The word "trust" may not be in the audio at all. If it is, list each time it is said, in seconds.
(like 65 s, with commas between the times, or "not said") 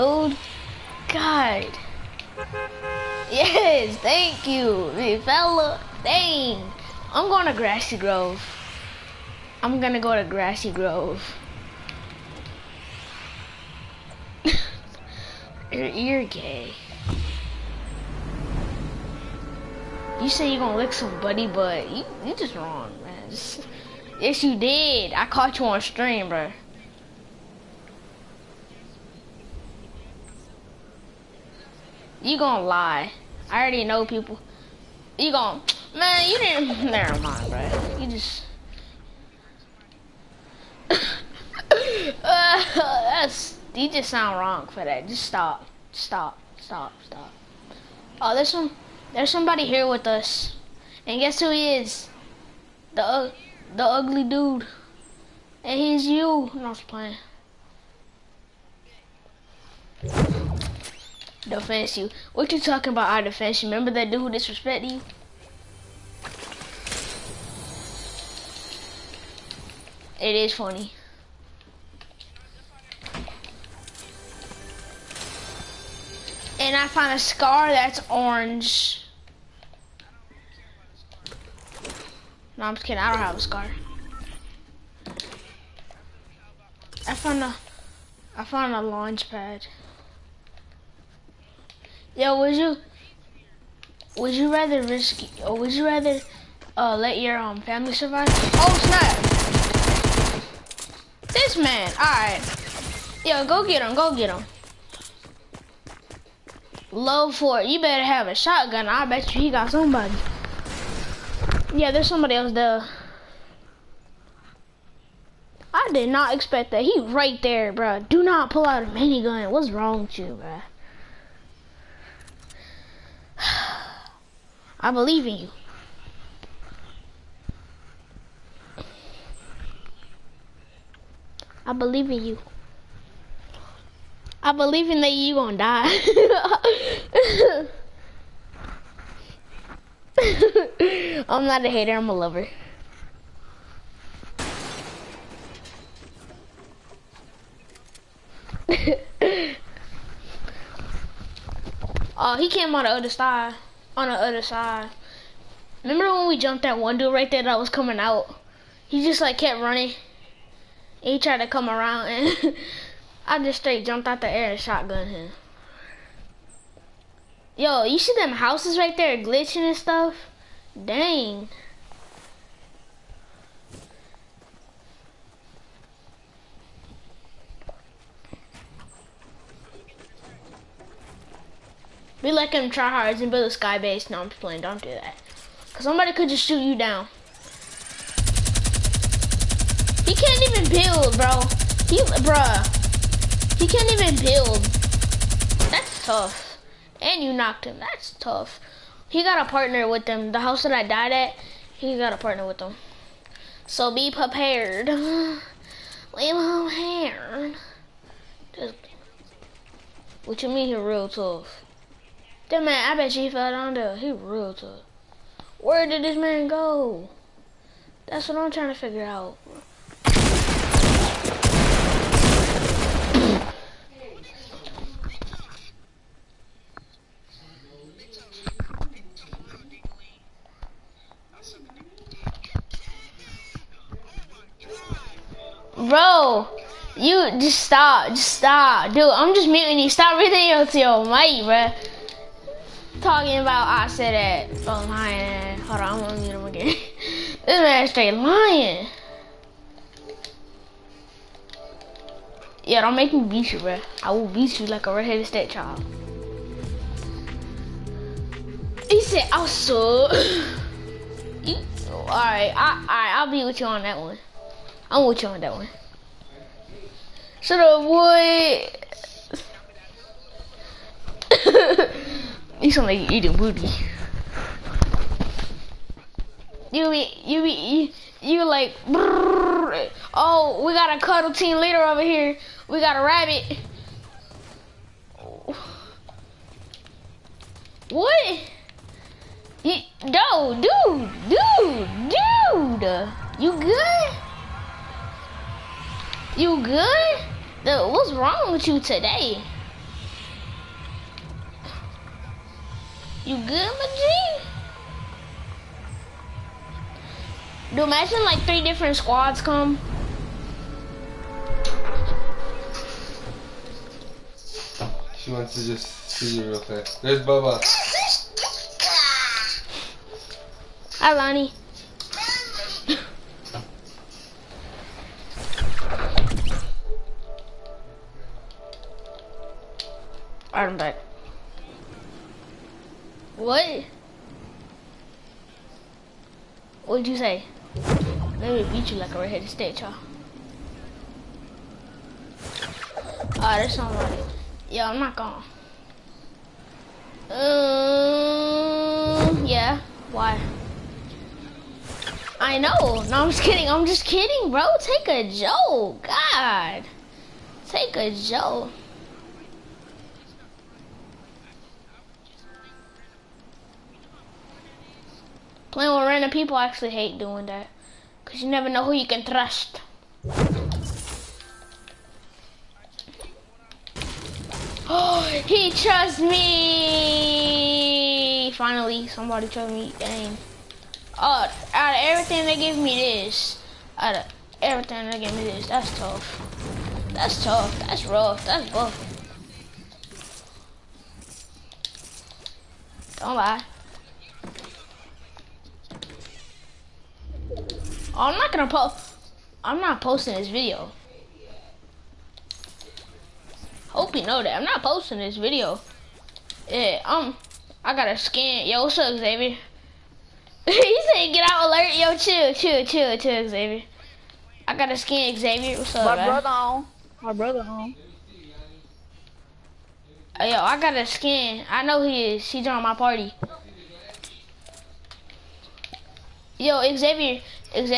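369 s, 375 s.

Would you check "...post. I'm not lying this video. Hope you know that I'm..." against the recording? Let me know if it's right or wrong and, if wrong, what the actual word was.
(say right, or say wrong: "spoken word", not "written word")
wrong: "posting", not "lying".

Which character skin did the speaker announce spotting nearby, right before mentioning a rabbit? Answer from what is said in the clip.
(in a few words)
Cuddle Team Leader.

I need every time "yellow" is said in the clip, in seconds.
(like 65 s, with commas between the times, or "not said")
not said.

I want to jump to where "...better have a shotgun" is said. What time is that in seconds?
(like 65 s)
107 s.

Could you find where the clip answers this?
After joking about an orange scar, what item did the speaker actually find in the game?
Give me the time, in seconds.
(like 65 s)
88 s.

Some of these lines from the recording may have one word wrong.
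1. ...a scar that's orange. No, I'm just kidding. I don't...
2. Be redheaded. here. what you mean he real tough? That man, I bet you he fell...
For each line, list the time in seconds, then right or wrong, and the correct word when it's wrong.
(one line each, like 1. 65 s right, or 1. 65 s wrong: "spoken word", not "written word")
1. 77 s right
2. 204 s wrong: "prepared", not "redheaded".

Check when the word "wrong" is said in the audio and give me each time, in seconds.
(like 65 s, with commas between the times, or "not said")
22 s, 44 s, 119 s, 298 s.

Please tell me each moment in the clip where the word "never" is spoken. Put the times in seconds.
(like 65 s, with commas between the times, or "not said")
36 s, 368 s.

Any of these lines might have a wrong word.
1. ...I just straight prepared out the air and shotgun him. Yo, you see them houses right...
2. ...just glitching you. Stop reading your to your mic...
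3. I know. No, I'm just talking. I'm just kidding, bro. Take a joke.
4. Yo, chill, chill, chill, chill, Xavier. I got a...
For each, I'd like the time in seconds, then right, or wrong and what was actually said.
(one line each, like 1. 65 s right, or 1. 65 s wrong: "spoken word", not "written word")
1. 163 s wrong: "jumped", not "prepared"
2. 239 s wrong: "muting", not "glitching"
3. 352 s wrong: "kidding", not "talking"
4. 411 s right.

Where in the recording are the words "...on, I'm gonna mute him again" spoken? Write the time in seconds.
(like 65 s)
245 s.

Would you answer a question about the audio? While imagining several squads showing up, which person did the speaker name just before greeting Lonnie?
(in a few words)
Bubba.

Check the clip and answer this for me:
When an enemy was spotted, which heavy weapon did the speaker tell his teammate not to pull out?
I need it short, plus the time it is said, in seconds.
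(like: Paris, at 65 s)
minigun, at 118 s.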